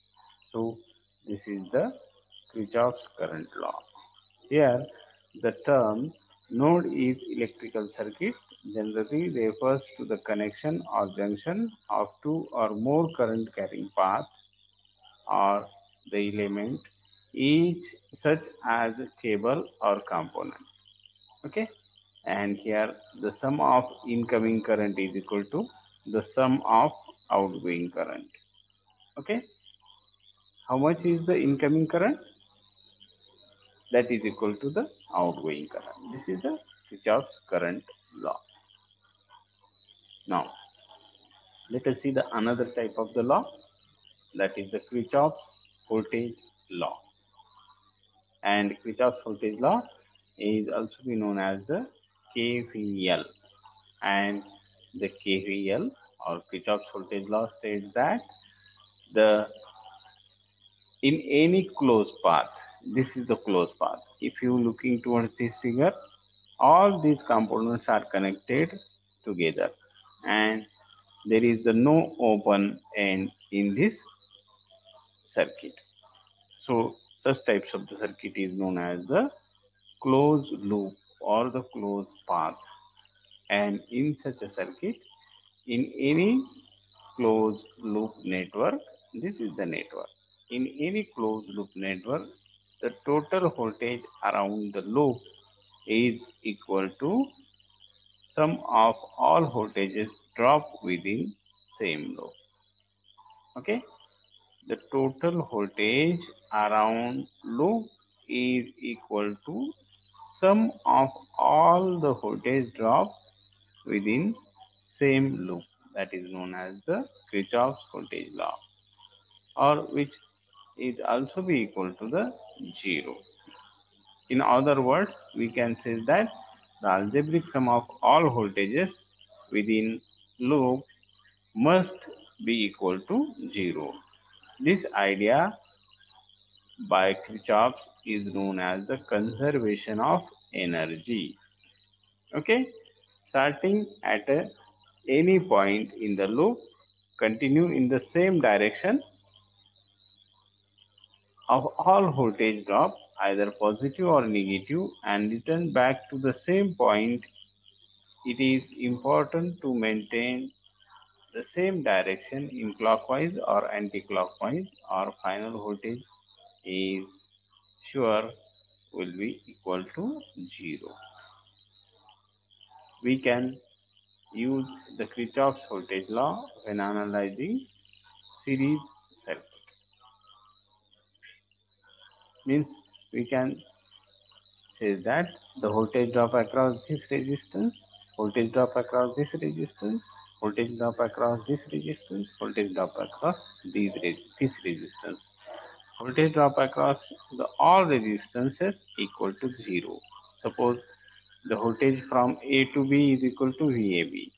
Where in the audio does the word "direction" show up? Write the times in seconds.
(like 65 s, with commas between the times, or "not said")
148 s, 161 s.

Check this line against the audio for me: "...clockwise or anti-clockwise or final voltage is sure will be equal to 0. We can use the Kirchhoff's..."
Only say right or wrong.
right.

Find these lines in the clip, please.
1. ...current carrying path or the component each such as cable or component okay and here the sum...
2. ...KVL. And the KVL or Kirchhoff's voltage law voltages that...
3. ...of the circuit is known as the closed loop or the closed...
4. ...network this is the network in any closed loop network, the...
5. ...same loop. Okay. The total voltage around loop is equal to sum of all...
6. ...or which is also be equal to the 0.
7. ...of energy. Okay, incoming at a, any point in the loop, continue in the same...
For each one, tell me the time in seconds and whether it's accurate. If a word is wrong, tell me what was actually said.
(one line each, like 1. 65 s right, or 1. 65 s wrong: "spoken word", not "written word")
1. 13 s wrong: "element", not "component"
2. 52 s wrong: "states", not "voltages"
3. 77 s right
4. 88 s right
5. 101 s right
6. 119 s right
7. 140 s wrong: "starting", not "incoming".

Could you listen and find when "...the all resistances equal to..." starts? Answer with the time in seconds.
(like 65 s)
197 s.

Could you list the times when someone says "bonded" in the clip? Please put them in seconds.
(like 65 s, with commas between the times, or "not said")
not said.